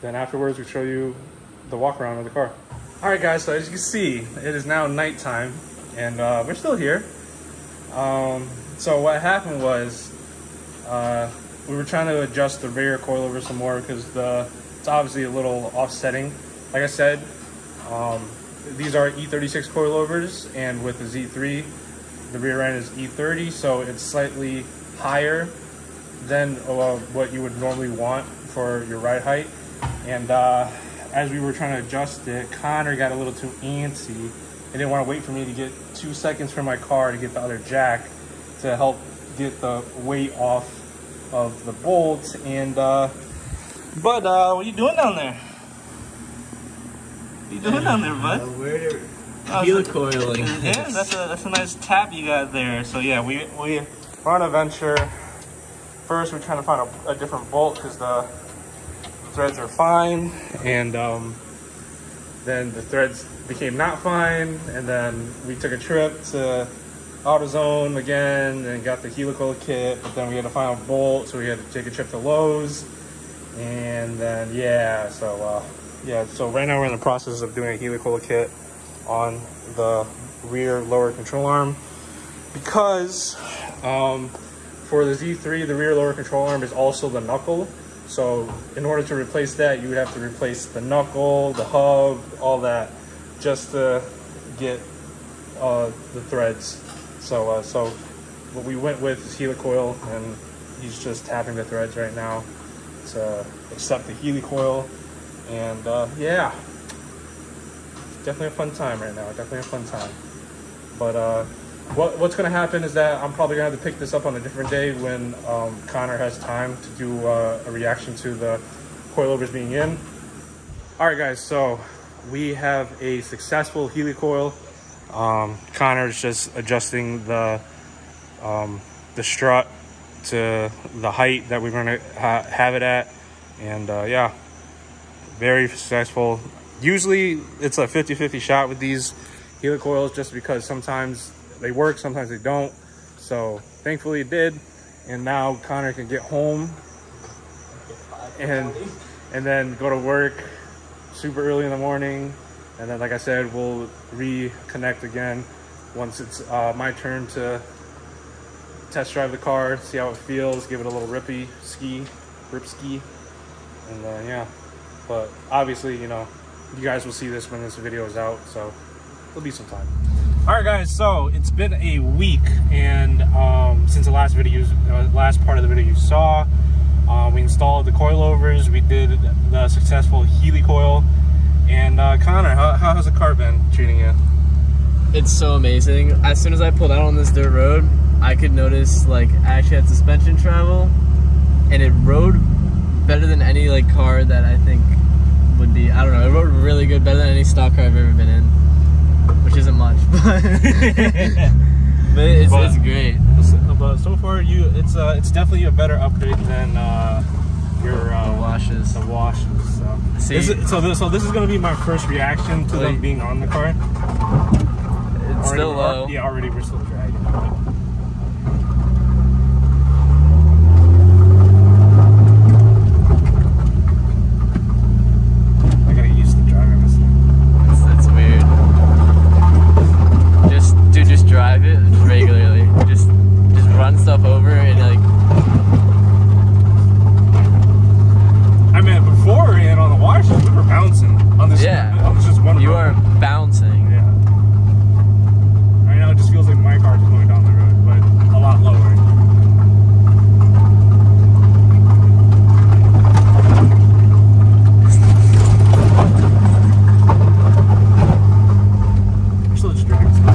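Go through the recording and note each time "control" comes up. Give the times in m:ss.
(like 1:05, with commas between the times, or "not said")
1:21, 1:26.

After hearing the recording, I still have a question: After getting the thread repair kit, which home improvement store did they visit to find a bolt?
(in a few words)
Lowe's.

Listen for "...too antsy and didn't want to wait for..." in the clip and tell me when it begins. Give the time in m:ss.
0:33.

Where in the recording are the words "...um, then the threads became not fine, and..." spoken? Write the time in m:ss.
1:00.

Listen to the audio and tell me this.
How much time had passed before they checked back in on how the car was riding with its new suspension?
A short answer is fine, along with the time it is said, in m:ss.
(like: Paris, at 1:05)
a week, at 2:51.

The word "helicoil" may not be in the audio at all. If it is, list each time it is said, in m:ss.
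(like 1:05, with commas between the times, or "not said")
1:09, 1:17, 1:39, 1:44, 2:03, 2:19, 3:00.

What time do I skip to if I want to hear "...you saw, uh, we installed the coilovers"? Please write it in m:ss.
2:55.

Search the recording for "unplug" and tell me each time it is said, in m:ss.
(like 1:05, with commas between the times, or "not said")
not said.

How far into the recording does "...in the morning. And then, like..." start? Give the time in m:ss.
2:31.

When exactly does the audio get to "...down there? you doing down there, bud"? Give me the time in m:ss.
0:44.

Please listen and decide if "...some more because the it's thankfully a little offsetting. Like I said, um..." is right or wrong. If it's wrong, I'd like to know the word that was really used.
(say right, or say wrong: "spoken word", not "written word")
wrong: "obviously", not "thankfully".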